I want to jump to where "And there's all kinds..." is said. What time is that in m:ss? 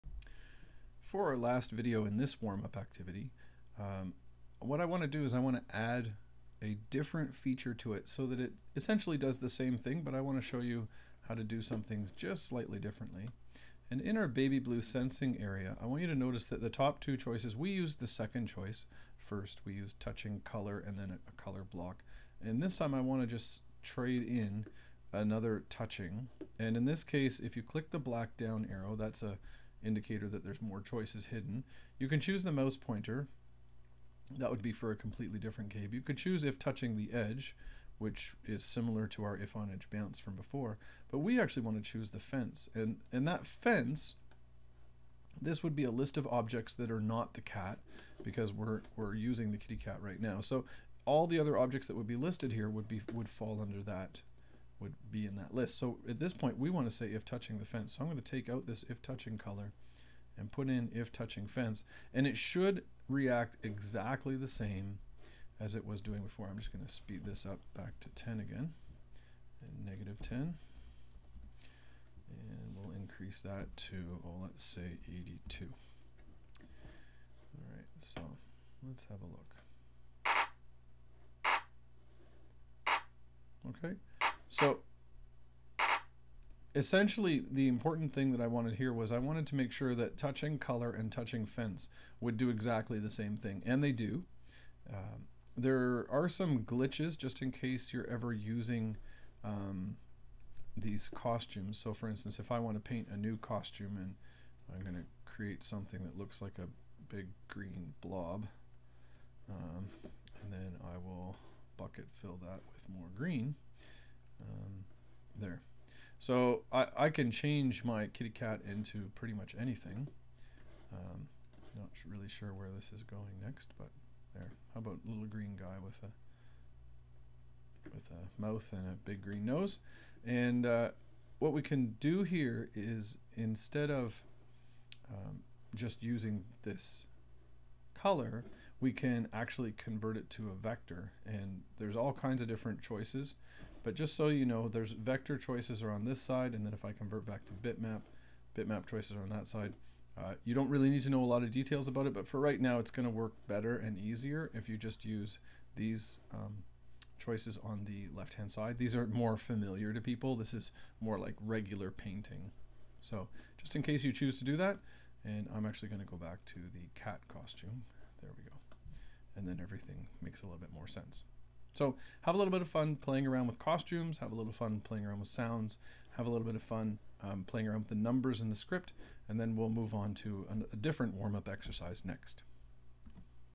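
2:21.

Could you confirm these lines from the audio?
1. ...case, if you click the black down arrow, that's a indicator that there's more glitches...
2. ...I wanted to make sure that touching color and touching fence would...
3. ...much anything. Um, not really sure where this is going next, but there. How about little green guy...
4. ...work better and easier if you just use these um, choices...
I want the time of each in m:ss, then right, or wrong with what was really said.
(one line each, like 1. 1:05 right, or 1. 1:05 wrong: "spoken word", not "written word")
1. 0:27 wrong: "choices", not "glitches"
2. 1:29 right
3. 1:59 right
4. 2:33 right.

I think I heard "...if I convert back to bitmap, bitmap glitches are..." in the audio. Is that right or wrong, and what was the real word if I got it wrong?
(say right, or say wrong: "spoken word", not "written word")
wrong: "choices", not "glitches".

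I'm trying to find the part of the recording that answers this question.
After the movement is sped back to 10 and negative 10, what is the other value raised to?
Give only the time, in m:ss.
1:15.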